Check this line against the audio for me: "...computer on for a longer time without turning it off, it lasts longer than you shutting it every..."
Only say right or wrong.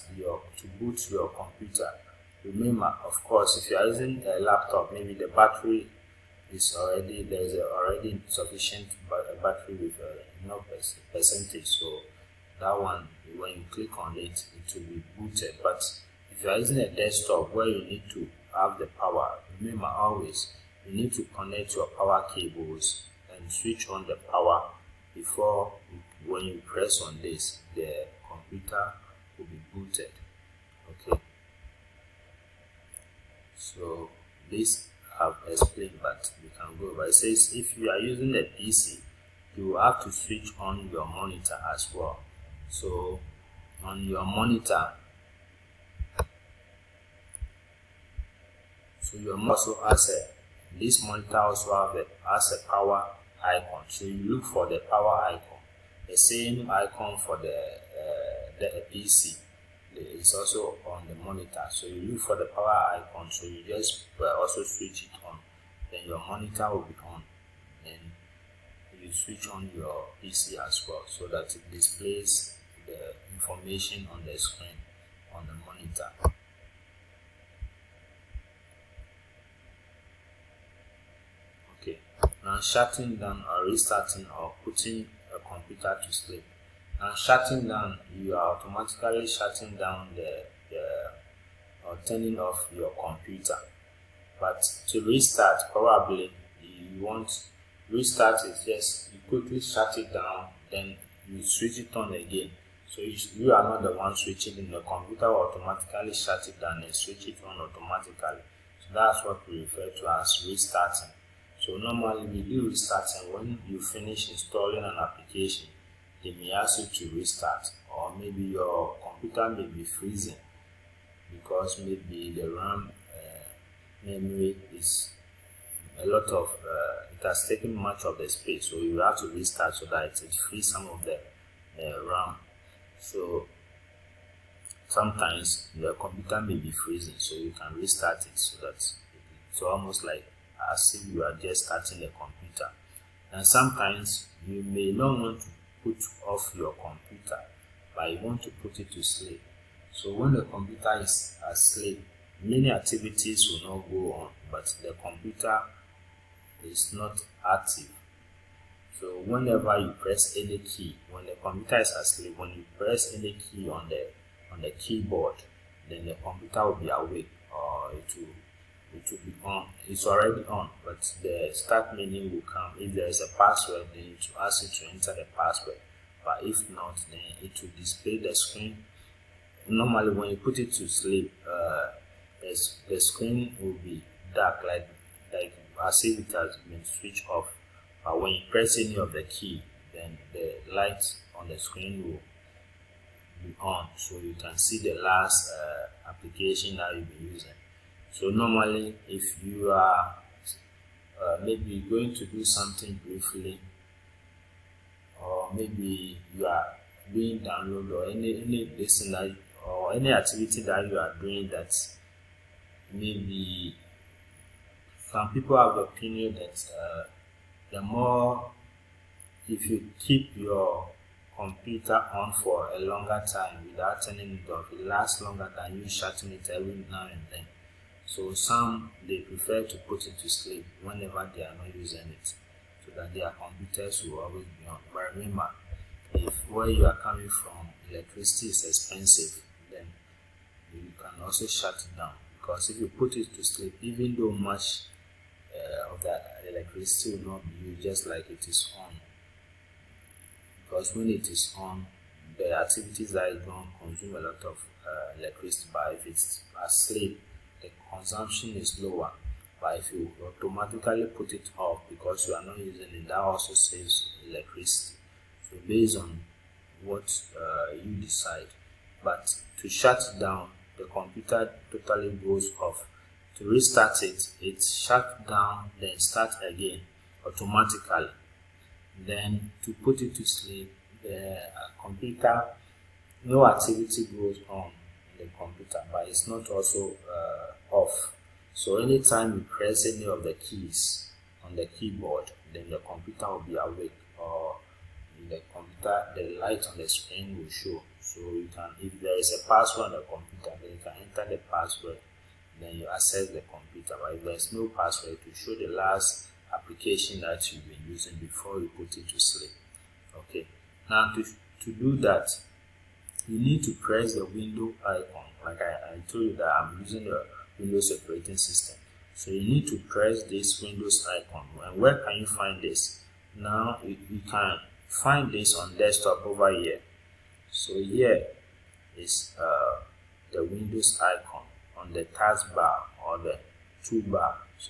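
right.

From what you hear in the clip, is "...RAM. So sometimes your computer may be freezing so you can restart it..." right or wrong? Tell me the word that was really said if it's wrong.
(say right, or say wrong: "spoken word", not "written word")
right.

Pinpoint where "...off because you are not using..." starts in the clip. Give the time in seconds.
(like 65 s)
261 s.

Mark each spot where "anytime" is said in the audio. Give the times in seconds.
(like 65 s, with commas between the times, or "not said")
288 s.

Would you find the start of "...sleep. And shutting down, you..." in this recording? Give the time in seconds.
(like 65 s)
86 s.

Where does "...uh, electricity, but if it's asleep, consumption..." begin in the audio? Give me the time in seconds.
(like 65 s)
254 s.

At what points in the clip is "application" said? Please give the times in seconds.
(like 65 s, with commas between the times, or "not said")
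114 s, 196 s, 306 s.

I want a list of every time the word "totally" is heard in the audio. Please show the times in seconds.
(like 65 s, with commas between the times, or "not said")
271 s.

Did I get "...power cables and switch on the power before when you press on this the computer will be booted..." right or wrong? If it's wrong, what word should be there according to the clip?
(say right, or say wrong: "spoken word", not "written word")
right.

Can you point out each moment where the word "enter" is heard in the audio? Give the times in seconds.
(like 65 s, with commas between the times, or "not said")
174 s, 301 s.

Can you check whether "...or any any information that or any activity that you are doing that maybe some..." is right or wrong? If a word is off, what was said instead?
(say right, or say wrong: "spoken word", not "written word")
wrong: "lesson", not "information".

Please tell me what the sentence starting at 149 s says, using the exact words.
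So when the computer is asleep, many activities will not go on, but the computer is not active.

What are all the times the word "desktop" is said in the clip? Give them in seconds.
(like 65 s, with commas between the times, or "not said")
16 s, 325 s.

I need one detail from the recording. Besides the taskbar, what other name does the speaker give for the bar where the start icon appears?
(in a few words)
toolbar.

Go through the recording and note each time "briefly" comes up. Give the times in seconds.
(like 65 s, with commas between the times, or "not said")
203 s.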